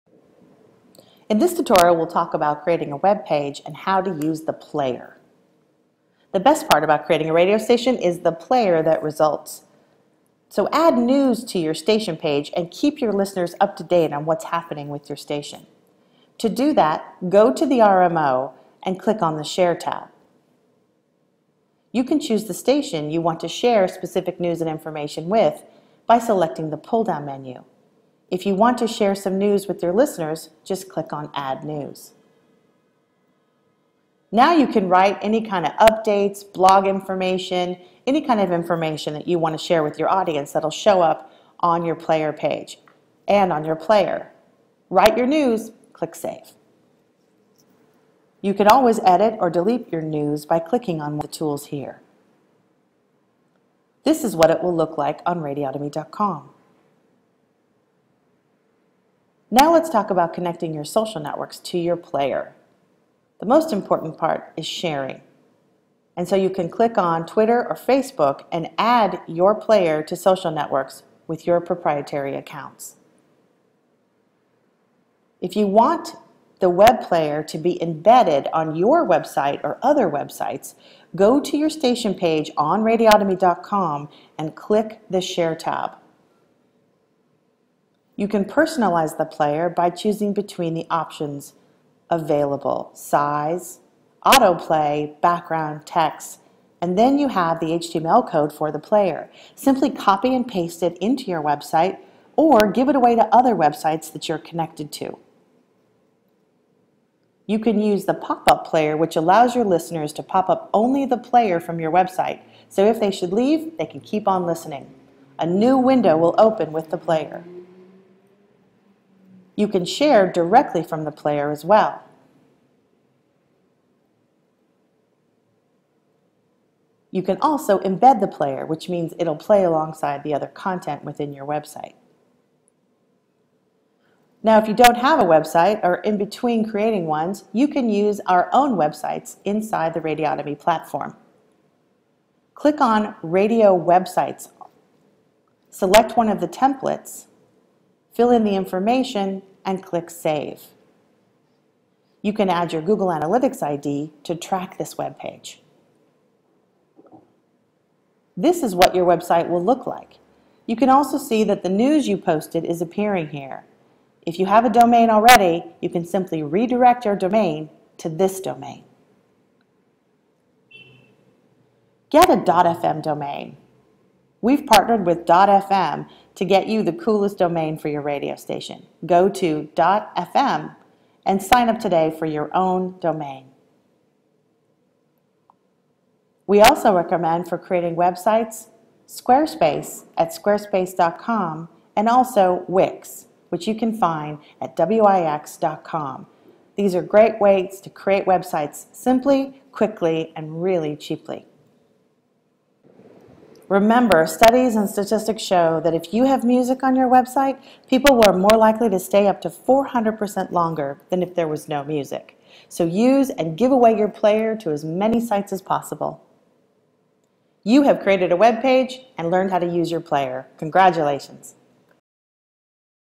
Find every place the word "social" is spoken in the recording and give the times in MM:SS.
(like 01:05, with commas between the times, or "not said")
01:00, 01:10.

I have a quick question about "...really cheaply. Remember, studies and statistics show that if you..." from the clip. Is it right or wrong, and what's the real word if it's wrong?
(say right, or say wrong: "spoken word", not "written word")
right.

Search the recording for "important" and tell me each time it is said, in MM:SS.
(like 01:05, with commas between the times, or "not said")
01:03.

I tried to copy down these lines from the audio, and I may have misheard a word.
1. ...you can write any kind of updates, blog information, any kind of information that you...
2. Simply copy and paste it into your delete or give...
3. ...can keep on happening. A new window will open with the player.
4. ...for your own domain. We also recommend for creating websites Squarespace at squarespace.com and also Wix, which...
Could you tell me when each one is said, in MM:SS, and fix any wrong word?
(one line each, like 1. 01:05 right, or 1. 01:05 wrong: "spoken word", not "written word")
1. 00:34 right
2. 01:39 wrong: "website", not "delete"
3. 01:53 wrong: "listening", not "happening"
4. 03:02 right.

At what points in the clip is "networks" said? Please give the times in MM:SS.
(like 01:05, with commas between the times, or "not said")
01:01, 01:10.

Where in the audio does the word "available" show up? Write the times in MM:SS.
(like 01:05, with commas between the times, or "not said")
01:32.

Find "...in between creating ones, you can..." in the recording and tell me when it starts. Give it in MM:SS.
02:15.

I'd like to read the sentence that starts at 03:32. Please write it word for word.
So use and give away your player to as many sites as possible.